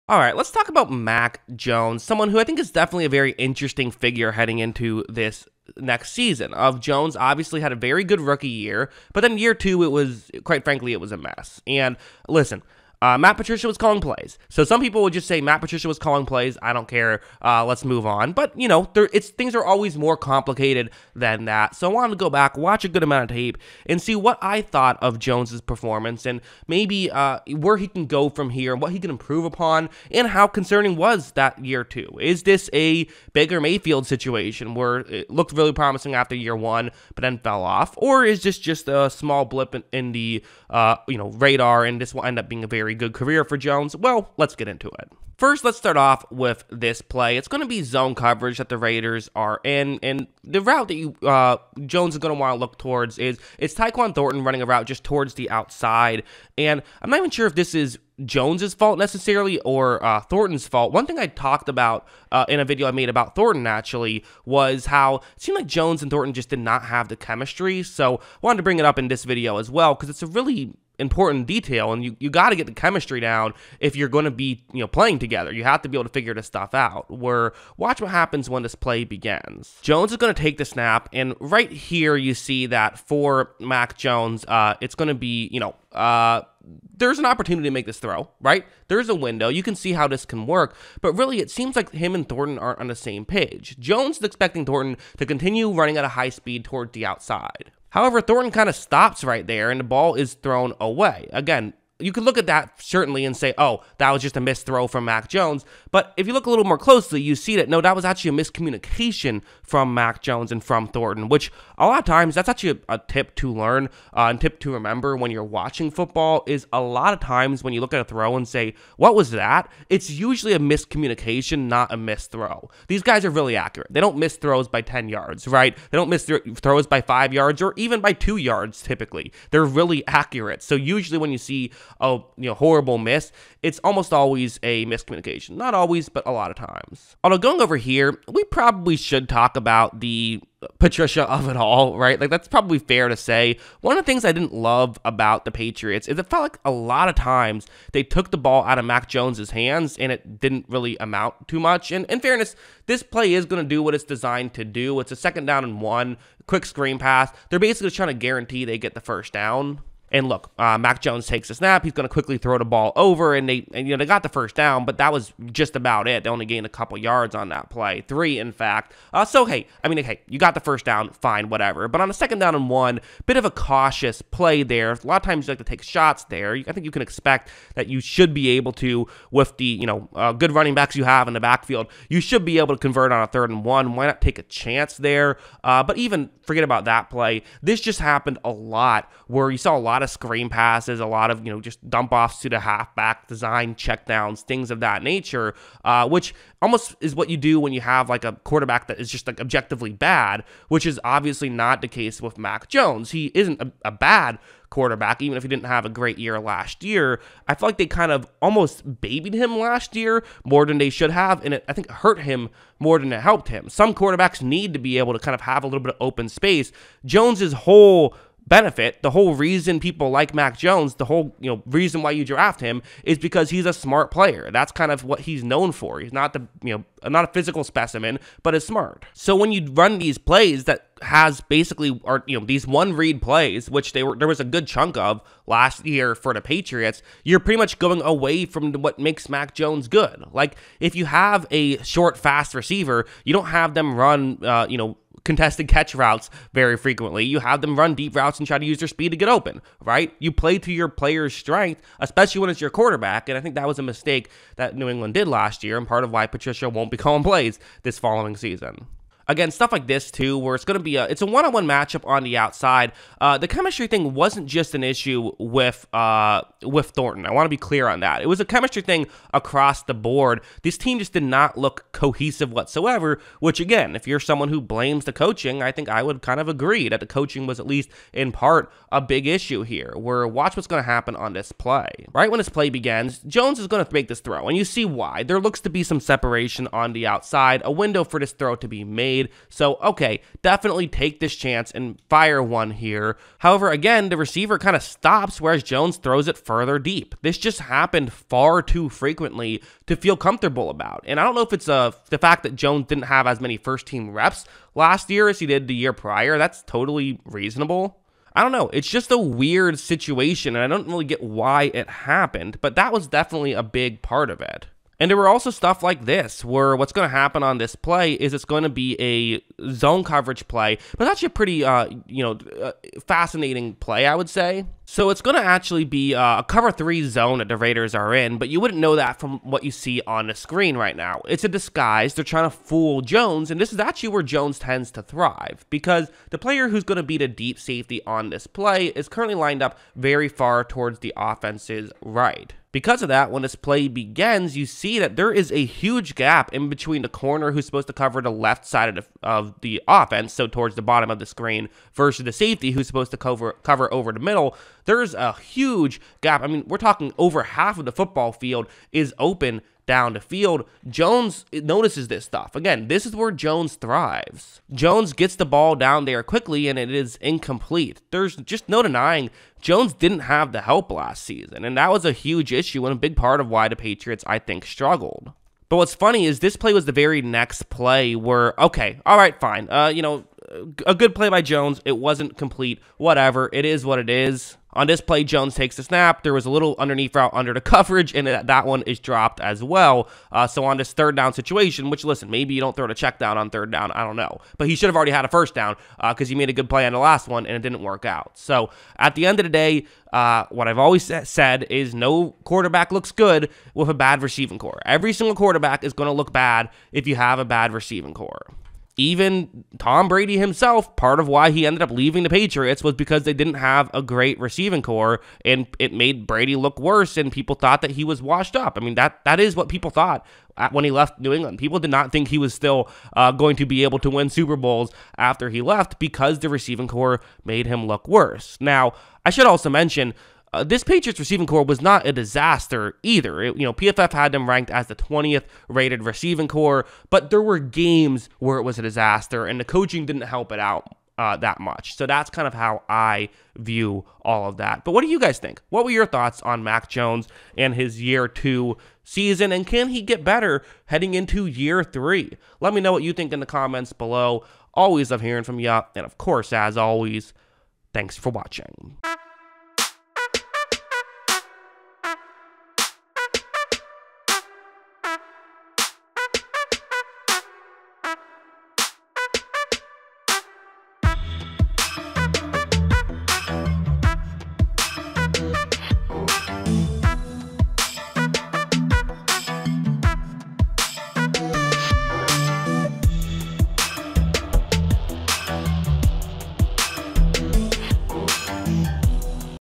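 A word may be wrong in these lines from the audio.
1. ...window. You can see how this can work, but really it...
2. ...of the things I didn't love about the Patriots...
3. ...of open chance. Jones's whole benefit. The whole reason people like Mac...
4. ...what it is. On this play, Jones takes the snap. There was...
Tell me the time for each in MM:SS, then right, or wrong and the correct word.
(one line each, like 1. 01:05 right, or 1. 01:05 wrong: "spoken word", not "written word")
1. 01:29 right
2. 02:23 right
3. 03:35 wrong: "space", not "chance"
4. 06:23 right.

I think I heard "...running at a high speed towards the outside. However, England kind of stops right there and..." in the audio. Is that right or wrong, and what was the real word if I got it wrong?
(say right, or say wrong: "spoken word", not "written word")
wrong: "Thornton", not "England".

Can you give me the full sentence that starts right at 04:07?
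You have them run deep routes and try to use their speed to get open, right?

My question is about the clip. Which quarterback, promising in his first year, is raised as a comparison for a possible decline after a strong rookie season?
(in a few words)
Baker Mayfield.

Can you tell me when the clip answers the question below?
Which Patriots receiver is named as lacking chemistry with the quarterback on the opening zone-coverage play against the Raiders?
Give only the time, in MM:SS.
00:53.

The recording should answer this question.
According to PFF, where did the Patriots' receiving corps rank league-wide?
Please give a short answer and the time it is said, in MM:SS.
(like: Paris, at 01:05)
20th, at 07:14.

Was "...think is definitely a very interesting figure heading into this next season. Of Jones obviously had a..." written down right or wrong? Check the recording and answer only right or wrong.
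right.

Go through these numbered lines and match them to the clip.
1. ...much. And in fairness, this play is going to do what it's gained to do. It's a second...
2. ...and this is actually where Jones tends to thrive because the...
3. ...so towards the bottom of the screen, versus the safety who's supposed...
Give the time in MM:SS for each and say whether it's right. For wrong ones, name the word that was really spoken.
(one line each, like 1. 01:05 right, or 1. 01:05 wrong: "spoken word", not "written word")
1. 02:31 wrong: "designed", not "gained"
2. 05:33 right
3. 05:50 right.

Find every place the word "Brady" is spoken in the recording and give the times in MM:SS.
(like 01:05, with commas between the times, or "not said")
06:50, 06:56.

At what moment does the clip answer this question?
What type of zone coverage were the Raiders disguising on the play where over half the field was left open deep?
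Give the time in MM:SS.
05:26.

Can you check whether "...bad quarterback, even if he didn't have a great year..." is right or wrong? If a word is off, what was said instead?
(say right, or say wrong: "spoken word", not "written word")
right.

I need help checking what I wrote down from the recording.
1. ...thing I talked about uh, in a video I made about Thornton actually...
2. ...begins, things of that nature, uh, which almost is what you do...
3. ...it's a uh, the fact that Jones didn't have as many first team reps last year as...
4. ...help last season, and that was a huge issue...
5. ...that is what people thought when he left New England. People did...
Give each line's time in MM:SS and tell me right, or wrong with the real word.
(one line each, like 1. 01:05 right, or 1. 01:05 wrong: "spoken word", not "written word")
1. 01:01 right
2. 03:13 wrong: "checkdowns", not "begins"
3. 05:01 right
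4. 06:10 right
5. 06:59 right.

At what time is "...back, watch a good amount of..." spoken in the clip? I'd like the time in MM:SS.
00:22.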